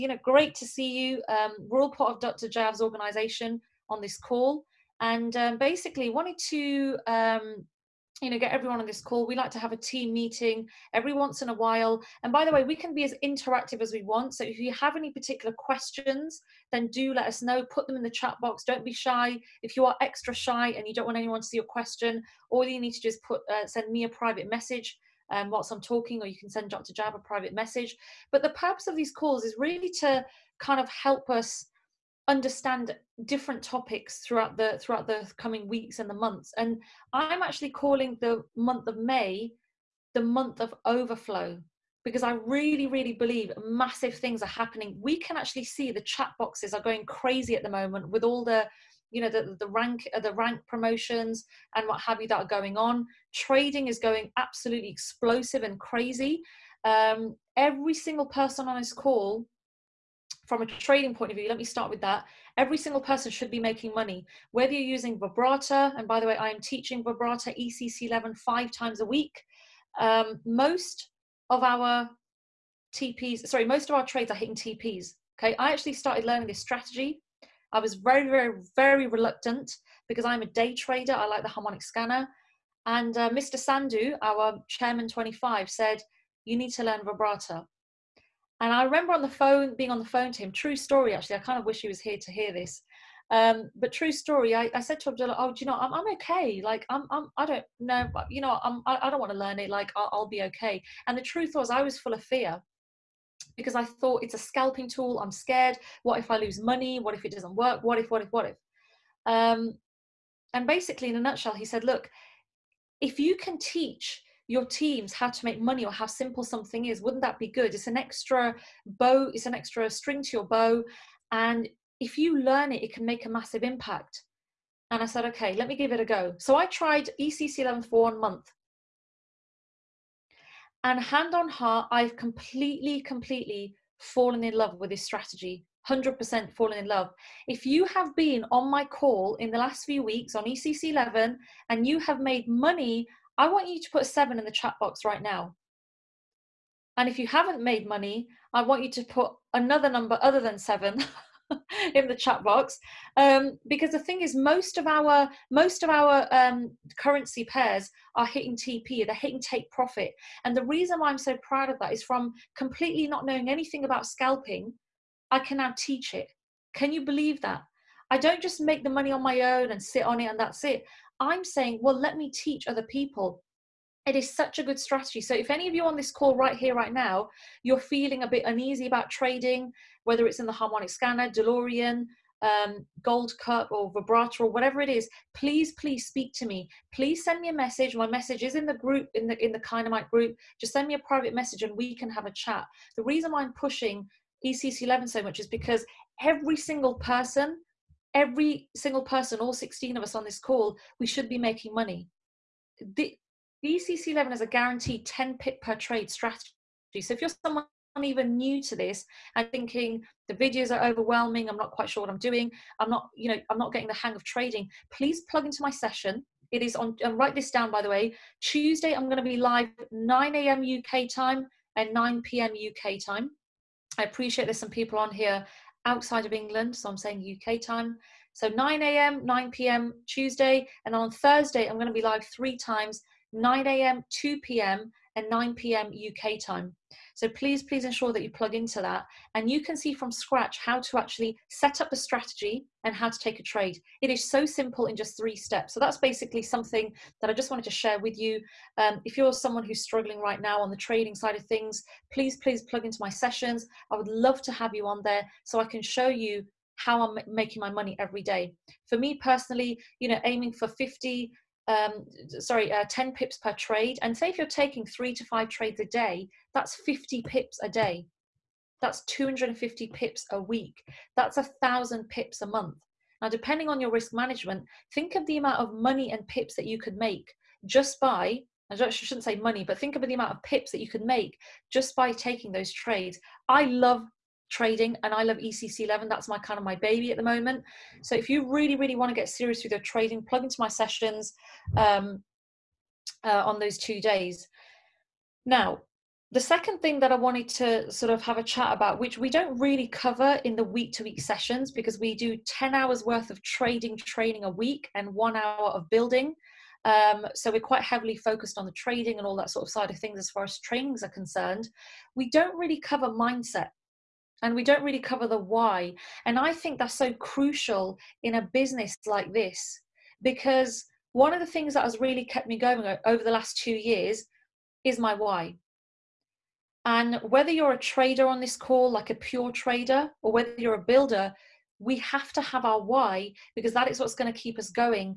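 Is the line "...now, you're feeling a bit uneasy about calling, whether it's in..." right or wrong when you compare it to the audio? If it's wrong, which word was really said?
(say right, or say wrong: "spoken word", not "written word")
wrong: "trading", not "calling".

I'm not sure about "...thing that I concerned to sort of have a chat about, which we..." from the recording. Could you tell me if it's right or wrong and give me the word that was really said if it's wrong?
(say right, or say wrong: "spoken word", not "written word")
wrong: "wanted", not "concerned".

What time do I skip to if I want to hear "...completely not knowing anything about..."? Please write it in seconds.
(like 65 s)
162 s.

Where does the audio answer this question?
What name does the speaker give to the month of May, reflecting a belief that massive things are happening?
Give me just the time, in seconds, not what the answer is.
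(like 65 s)
40 s.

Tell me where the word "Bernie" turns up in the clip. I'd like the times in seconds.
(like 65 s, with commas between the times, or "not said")
not said.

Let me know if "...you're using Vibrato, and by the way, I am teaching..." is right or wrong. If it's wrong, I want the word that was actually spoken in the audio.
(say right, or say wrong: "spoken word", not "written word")
right.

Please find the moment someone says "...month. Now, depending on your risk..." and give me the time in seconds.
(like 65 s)
272 s.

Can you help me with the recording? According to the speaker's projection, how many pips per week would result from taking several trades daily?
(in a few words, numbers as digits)
250.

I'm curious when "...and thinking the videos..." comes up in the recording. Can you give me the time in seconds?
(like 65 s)
209 s.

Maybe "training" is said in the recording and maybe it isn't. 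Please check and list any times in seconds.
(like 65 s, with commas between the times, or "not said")
303 s, 310 s.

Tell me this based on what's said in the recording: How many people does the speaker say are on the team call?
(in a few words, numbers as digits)
16.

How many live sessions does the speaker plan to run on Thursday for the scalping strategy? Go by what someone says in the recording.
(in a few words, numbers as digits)
3.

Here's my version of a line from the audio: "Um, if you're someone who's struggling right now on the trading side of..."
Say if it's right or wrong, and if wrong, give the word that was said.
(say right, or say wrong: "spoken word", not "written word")
right.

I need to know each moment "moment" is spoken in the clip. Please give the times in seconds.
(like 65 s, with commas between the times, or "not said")
47 s, 287 s.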